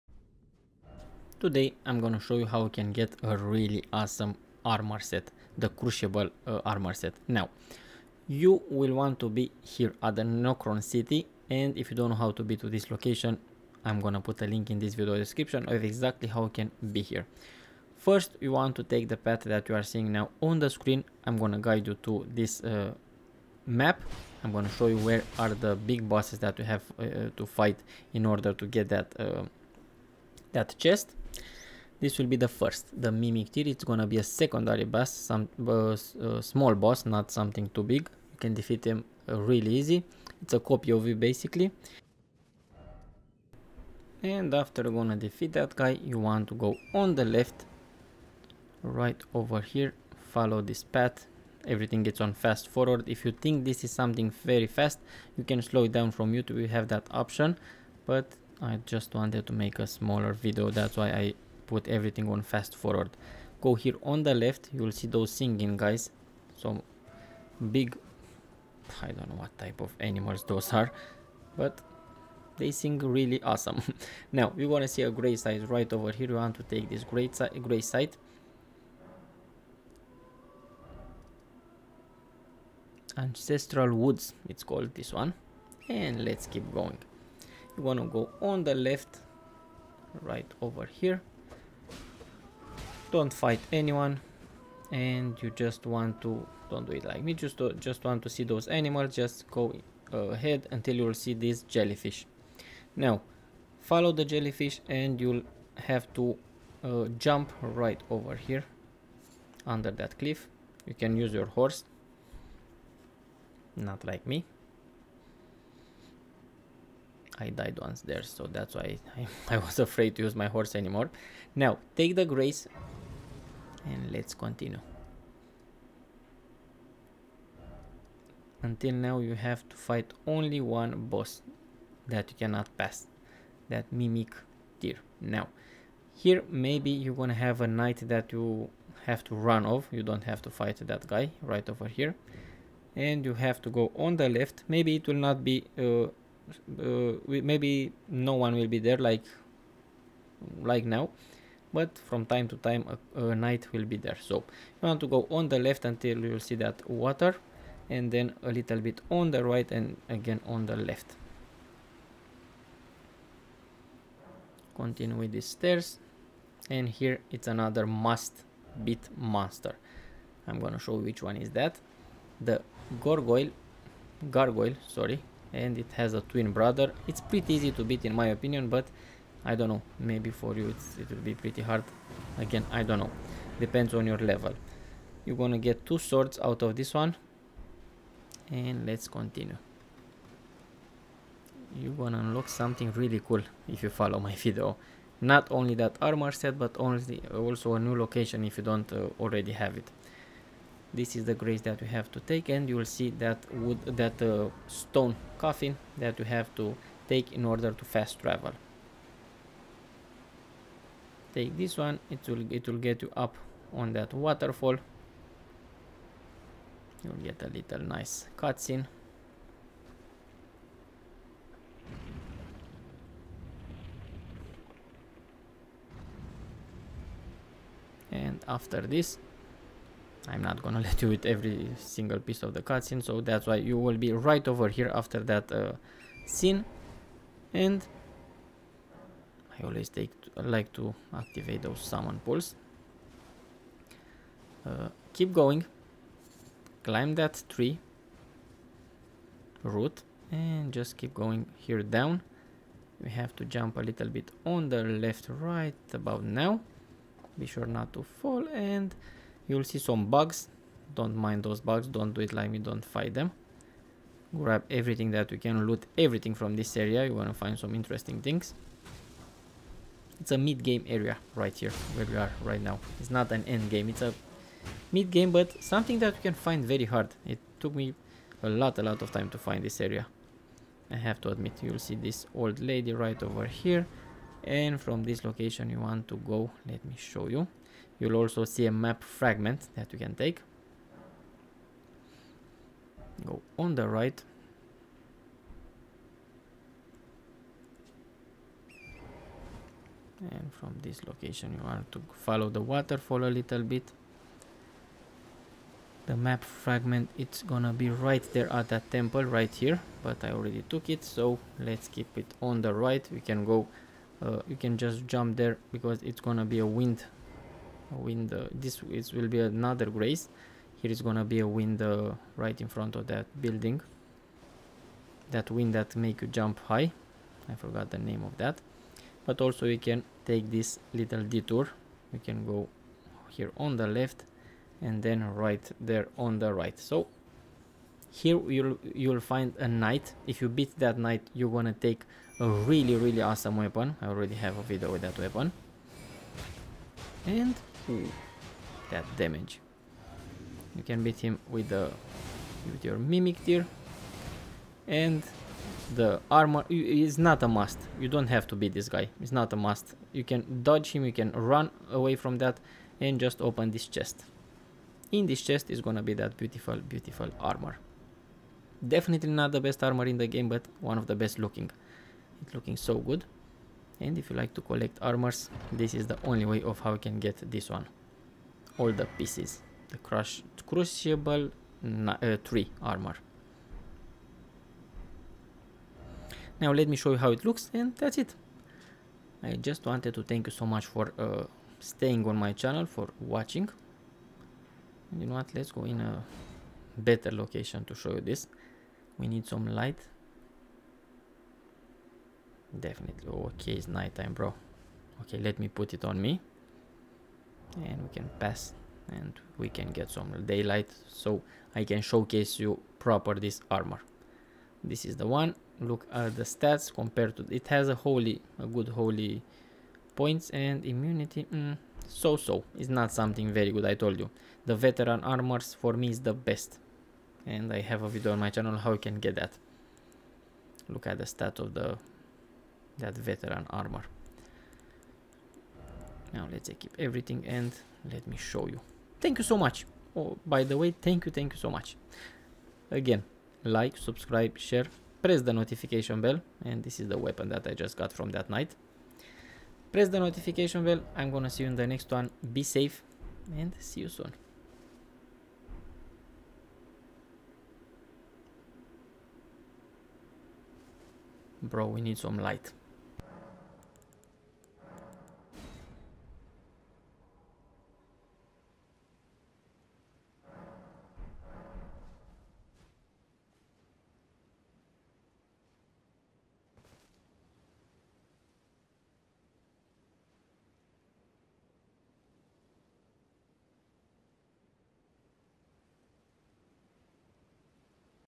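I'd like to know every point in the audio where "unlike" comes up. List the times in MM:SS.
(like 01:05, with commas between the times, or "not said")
not said.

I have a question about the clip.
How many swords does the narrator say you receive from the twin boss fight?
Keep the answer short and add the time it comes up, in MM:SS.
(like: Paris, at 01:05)
2, at 03:05.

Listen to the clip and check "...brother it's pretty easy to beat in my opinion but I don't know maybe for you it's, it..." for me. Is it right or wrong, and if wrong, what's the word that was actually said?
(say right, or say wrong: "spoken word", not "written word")
right.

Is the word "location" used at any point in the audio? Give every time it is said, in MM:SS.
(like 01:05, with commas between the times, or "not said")
00:12, 03:17, 04:45, 05:01, 06:37.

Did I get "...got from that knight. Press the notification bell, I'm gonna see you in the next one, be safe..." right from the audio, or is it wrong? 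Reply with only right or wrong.
right.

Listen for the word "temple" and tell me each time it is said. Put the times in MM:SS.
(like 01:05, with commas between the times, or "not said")
05:08.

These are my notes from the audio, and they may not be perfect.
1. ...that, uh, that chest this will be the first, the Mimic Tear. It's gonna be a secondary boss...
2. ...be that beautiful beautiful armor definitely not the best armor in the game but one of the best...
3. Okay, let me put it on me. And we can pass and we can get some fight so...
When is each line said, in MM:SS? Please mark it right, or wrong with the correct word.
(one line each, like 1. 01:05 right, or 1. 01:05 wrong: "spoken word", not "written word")
1. 00:28 right
2. 06:06 right
3. 06:45 wrong: "daylight", not "fight".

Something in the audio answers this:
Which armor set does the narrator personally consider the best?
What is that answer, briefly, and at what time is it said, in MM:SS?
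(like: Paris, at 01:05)
veteran armor, at 07:04.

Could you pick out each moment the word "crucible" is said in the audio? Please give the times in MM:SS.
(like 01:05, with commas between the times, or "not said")
00:05, 06:20.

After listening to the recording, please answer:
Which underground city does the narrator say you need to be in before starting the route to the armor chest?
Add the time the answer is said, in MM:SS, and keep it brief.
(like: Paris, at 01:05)
Nokron City, at 00:10.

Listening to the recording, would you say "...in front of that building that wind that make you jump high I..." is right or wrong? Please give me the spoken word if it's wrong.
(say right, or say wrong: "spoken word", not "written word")
right.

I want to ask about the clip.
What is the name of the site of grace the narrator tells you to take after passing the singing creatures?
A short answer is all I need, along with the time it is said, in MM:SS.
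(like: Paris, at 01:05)
Ancestral Woods, at 01:23.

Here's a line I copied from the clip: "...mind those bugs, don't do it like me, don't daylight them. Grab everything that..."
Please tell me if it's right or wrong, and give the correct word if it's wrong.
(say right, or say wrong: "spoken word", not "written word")
wrong: "fight", not "daylight".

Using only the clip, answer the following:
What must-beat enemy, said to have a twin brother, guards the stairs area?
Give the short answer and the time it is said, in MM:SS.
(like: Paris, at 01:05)
gargoyle, at 02:52.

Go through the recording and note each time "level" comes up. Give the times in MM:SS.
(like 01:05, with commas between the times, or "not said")
03:04.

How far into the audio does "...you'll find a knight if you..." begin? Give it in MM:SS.
05:38.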